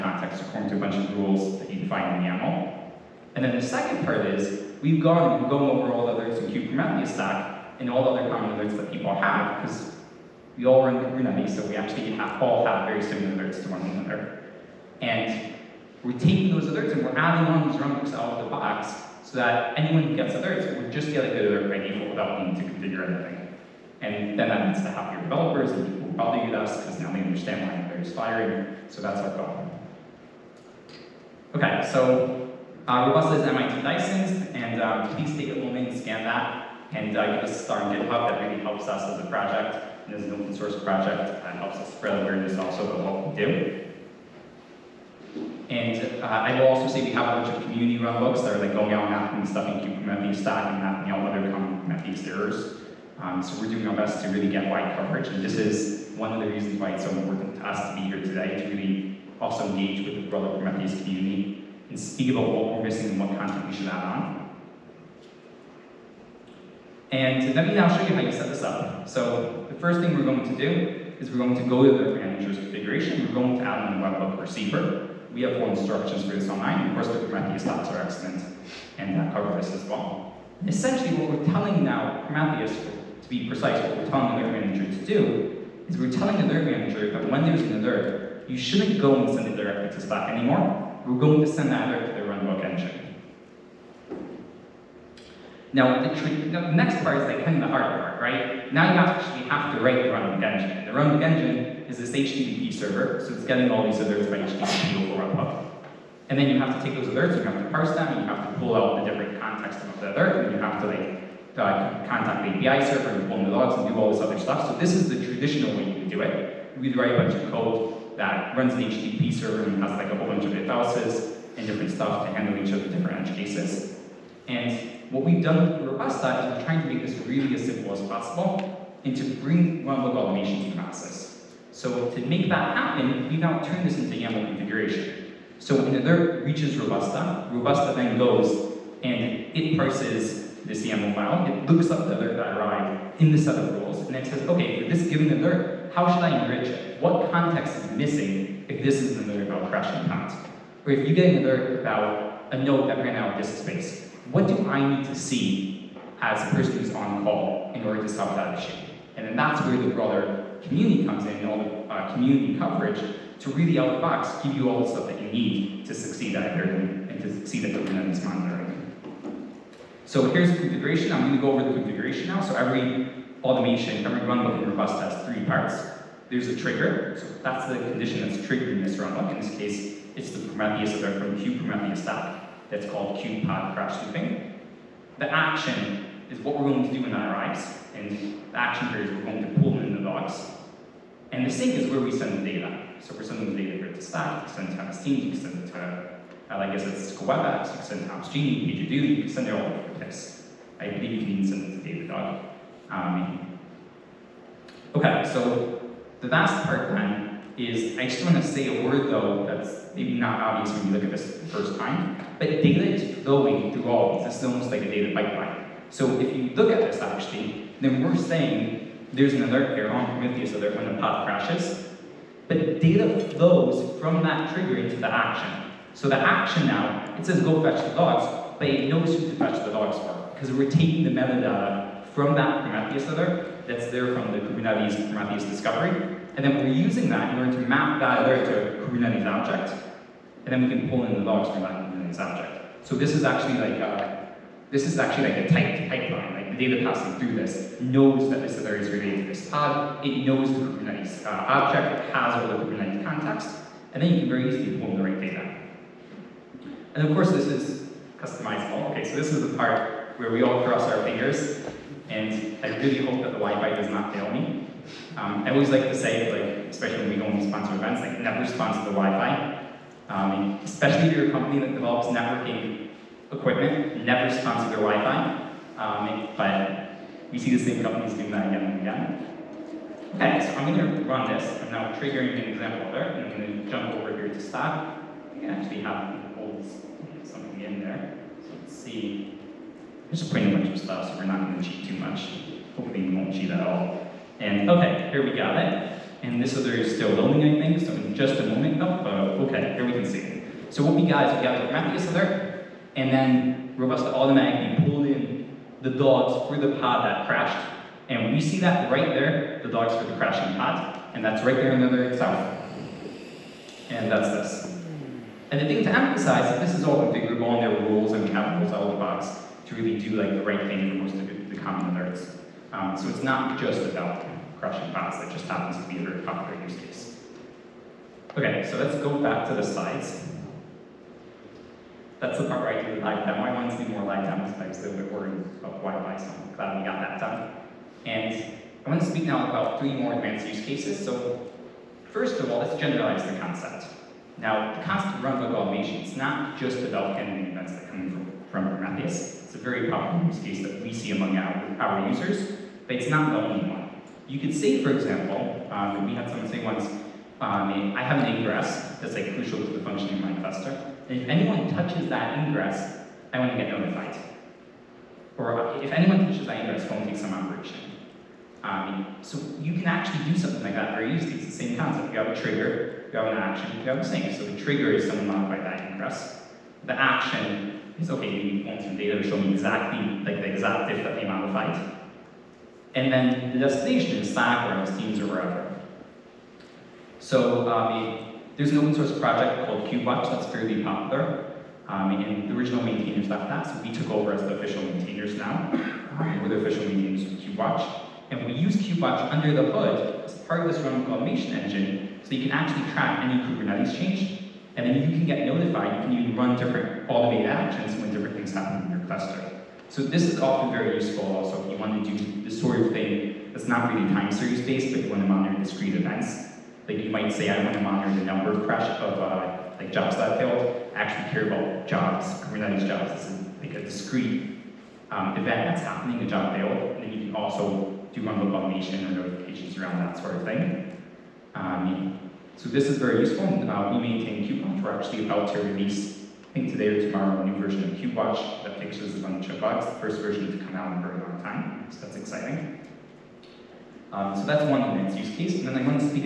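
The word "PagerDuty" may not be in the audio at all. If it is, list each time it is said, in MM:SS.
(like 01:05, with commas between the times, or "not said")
03:18.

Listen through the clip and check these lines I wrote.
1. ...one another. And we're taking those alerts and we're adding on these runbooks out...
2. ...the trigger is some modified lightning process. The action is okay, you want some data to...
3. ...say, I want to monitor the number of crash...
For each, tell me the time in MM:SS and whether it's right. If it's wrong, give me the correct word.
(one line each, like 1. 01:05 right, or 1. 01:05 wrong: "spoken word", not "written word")
1. 00:13 right
2. 06:14 wrong: "press", not "process"
3. 06:57 right.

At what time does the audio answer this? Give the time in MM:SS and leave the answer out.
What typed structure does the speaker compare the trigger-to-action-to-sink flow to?
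03:34.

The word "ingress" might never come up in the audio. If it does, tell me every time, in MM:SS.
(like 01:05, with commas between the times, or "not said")
05:58, 06:02, 06:06.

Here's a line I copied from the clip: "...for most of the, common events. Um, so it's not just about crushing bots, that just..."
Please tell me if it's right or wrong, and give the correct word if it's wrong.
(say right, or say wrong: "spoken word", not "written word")
wrong: "alerts", not "events".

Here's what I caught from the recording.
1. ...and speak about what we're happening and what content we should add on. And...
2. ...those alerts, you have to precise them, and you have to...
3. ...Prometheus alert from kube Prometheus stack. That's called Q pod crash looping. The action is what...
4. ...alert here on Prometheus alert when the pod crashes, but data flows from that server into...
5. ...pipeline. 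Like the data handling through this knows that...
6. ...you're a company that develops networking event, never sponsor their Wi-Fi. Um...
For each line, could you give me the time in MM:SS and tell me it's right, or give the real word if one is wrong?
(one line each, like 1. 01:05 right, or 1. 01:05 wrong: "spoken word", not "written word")
1. 01:01 wrong: "missing", not "happening"
2. 01:46 wrong: "parse", not "precise"
3. 03:00 right
4. 03:39 wrong: "trigger", not "server"
5. 04:05 wrong: "passing", not "handling"
6. 04:31 wrong: "equipment", not "event".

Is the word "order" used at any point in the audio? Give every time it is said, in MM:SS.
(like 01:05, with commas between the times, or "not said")
02:37, 03:57.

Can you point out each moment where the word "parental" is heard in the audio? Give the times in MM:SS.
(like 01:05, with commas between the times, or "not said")
not said.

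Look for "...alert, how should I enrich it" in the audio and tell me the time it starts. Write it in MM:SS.
02:25.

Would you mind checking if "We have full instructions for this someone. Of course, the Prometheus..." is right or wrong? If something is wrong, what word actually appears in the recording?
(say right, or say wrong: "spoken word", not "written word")
wrong: "online", not "someone".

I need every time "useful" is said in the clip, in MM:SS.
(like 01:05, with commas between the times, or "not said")
06:50, 07:13.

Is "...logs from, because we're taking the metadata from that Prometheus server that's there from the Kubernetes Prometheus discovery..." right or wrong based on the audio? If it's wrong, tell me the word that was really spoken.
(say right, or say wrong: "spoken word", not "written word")
right.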